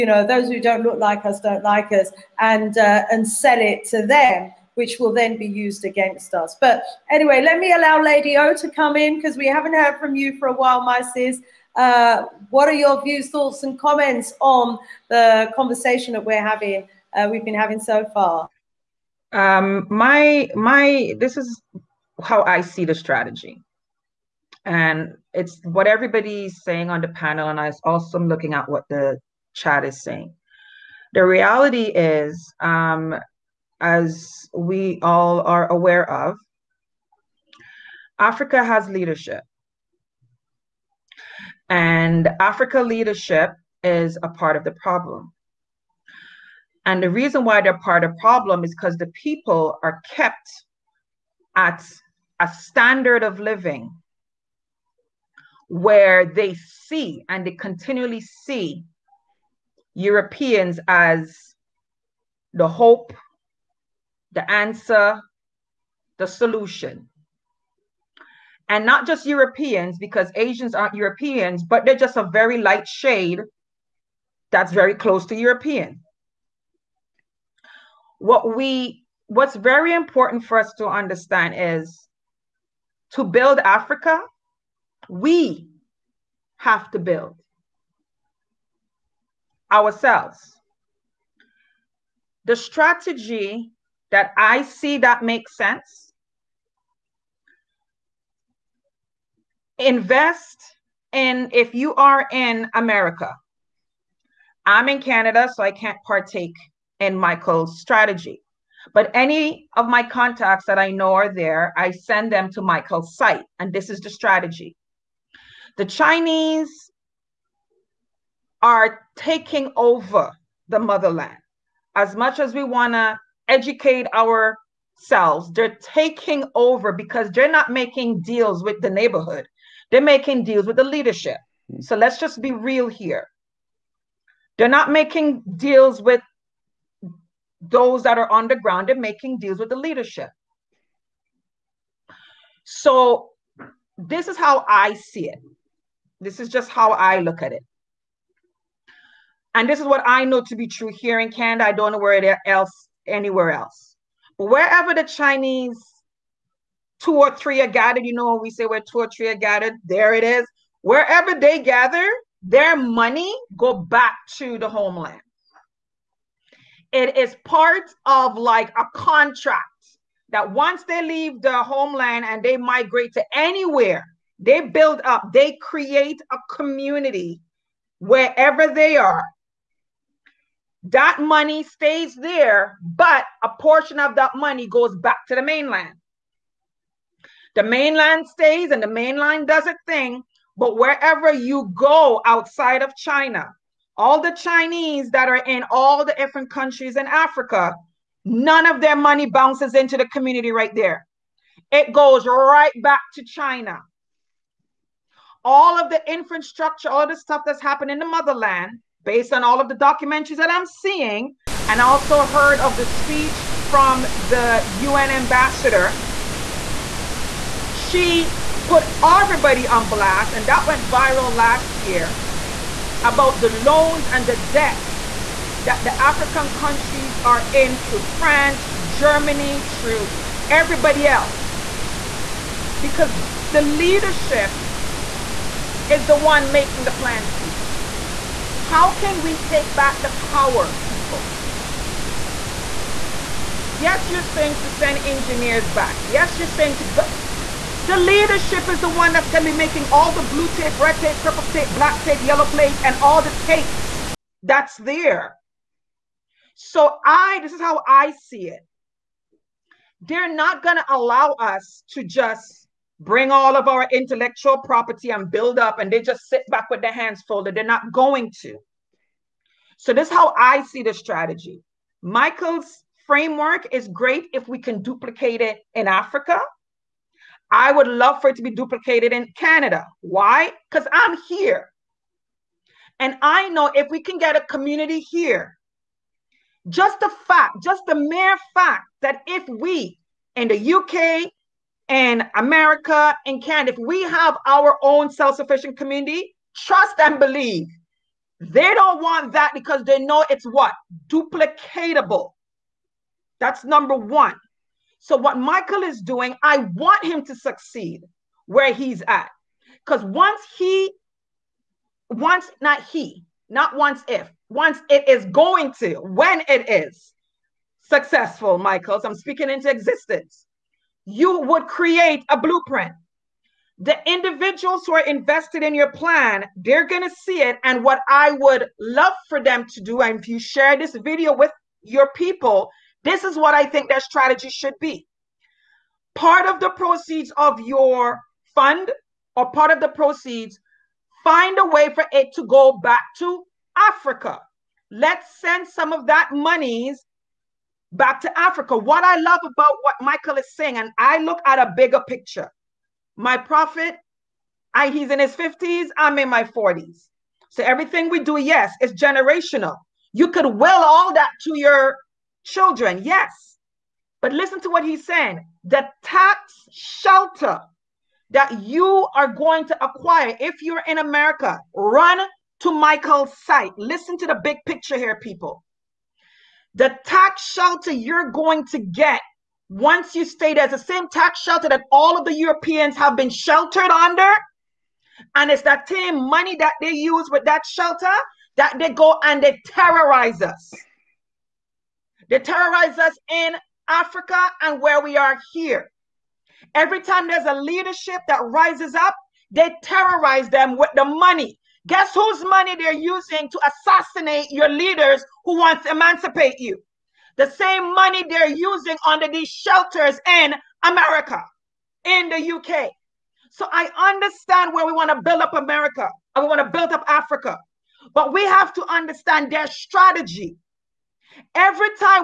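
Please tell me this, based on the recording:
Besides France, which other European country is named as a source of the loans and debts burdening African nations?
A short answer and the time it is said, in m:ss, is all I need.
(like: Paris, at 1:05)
Germany, at 3:48.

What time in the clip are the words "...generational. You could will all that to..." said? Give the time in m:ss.
5:58.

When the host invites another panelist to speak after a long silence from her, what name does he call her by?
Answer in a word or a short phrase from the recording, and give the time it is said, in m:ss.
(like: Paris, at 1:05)
Lady O, at 0:07.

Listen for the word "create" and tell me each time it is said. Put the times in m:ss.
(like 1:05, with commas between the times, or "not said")
2:55, 5:21.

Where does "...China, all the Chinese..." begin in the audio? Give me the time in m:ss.
3:12.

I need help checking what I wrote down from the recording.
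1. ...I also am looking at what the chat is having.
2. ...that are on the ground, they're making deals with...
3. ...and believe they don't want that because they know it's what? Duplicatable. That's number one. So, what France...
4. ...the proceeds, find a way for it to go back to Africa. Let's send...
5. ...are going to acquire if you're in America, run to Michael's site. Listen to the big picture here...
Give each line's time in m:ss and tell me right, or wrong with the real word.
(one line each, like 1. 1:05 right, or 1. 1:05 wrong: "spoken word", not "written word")
1. 0:27 wrong: "saying", not "having"
2. 2:18 right
3. 4:56 wrong: "Michael", not "France"
4. 5:39 right
5. 6:09 right.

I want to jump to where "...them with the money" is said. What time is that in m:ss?
6:40.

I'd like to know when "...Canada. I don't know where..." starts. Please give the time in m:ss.
2:31.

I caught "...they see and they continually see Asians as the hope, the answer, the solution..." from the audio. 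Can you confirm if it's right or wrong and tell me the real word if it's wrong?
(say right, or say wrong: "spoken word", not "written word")
wrong: "Europeans", not "Asians".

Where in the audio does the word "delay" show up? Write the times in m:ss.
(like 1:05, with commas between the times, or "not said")
not said.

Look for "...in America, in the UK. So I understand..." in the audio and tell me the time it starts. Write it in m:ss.
6:50.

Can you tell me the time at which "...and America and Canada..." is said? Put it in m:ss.
4:51.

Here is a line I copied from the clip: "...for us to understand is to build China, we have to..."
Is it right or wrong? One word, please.
wrong.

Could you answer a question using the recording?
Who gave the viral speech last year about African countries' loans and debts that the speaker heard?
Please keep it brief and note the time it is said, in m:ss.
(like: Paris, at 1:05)
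The UN ambassador, at 3:34.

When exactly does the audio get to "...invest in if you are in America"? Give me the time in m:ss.
1:39.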